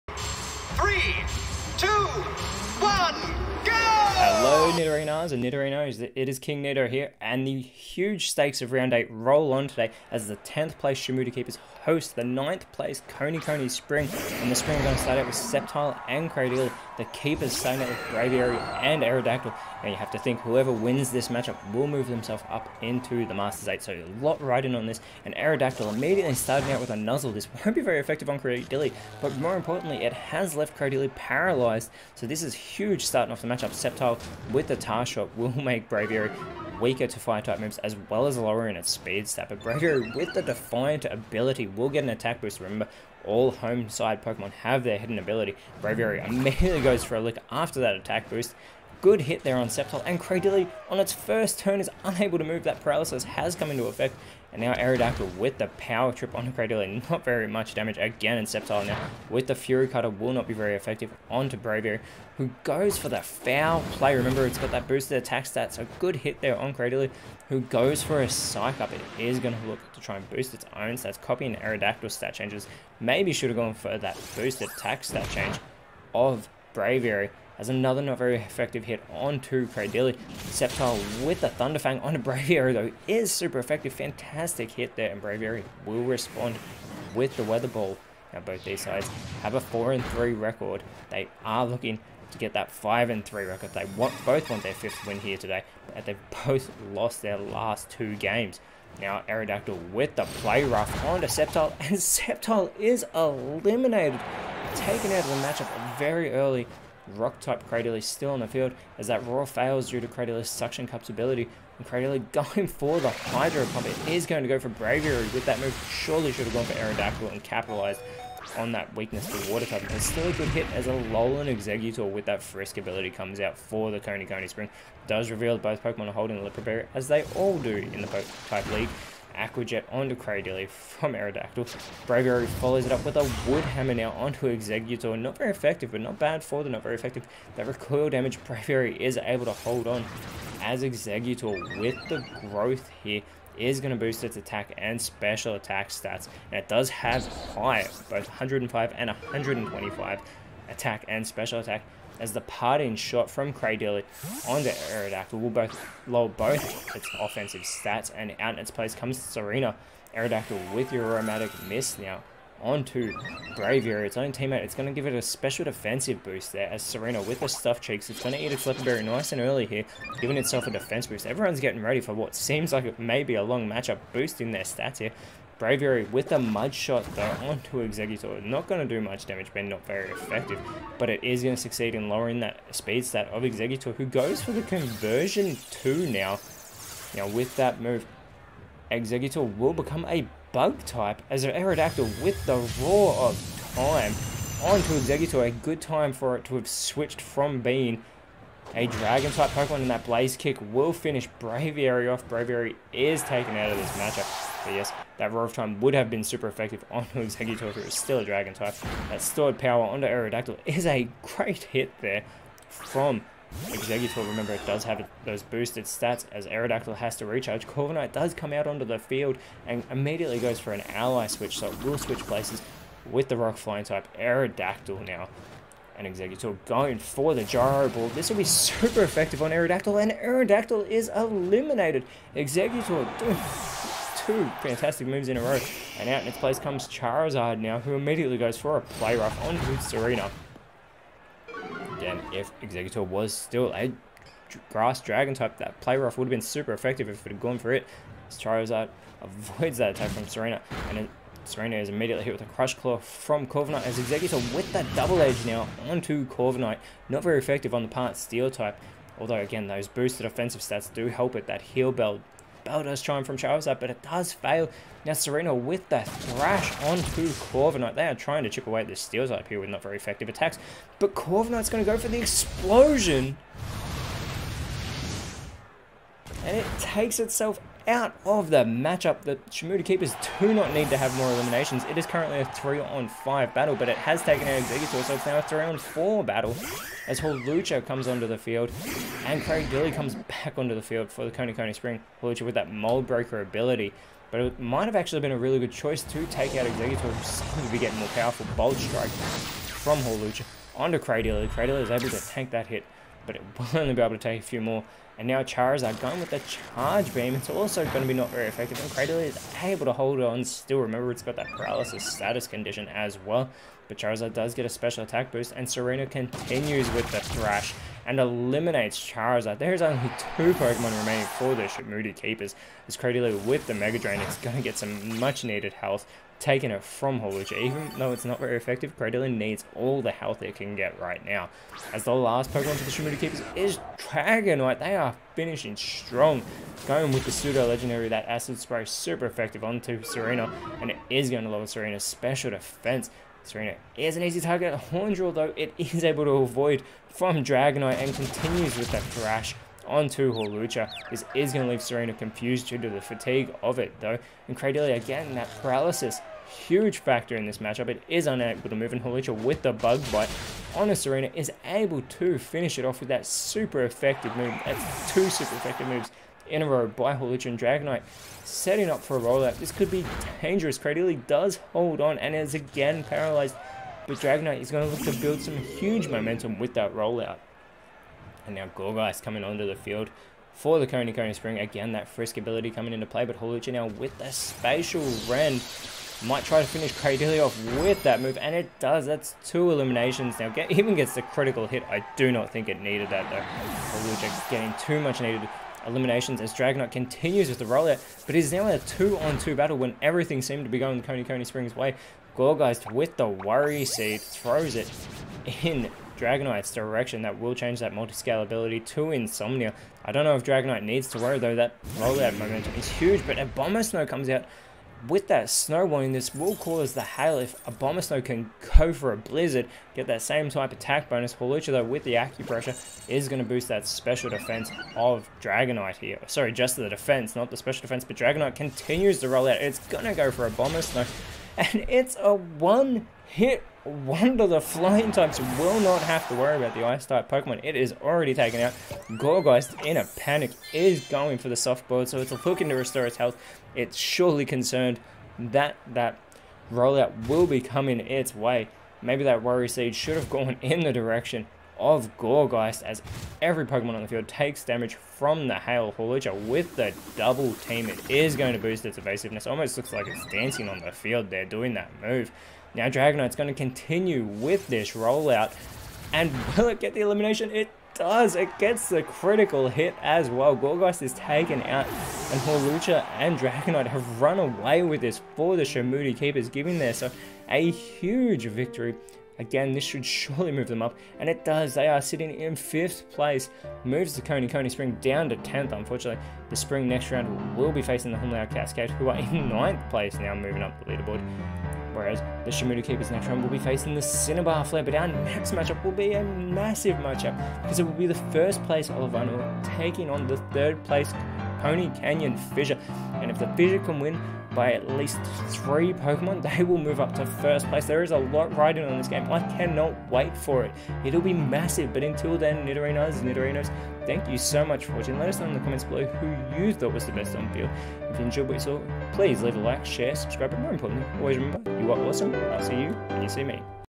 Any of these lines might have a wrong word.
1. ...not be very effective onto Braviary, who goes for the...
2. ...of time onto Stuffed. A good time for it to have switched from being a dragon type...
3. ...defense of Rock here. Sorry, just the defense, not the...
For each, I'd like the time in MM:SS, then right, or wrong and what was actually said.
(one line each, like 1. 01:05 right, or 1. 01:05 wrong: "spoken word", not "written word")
1. 01:00 right
2. 03:13 wrong: "Exeggutor", not "Stuffed"
3. 07:04 wrong: "Dragonite", not "Rock".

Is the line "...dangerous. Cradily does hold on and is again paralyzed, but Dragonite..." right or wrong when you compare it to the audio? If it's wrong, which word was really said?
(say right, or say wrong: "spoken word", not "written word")
right.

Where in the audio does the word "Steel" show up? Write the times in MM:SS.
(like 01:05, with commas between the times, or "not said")
04:18, 04:29.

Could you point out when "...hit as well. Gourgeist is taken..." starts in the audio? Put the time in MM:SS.
07:49.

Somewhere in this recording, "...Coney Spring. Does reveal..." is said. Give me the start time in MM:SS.
02:04.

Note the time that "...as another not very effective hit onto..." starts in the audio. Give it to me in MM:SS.
01:17.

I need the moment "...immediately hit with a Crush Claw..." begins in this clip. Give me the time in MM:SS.
04:11.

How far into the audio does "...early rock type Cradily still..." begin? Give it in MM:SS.
01:46.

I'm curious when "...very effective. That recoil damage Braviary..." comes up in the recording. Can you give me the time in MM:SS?
02:16.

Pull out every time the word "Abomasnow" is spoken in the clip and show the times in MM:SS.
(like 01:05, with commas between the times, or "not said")
06:53, 06:57, 07:10.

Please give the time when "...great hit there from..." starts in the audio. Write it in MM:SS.
03:31.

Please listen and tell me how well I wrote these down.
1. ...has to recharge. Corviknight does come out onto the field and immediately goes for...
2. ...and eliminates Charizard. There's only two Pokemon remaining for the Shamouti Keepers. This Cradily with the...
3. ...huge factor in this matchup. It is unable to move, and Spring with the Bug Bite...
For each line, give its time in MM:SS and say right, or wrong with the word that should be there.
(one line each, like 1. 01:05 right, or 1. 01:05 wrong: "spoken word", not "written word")
1. 03:36 right
2. 05:18 right
3. 05:56 wrong: "Hawlucha", not "Spring".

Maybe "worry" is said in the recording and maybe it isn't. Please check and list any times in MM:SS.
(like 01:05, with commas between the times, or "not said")
06:43, 06:51, 07:16, 07:29.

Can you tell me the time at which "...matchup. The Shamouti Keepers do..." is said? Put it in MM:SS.
04:38.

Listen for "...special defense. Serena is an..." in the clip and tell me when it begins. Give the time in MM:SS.
05:42.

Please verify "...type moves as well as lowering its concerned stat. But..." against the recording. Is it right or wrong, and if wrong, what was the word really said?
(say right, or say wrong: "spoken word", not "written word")
wrong: "speed", not "concerned".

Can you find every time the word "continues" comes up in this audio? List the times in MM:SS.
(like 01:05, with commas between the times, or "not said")
05:16, 05:48, 06:36, 07:08, 07:43.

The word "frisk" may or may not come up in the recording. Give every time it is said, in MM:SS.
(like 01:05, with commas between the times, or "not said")
02:02, 06:22.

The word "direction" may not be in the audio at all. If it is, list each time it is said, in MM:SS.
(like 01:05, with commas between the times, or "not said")
06:46, 07:30.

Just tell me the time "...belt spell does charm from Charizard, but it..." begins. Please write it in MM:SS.
04:21.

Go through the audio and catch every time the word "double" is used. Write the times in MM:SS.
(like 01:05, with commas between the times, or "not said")
04:14, 07:37.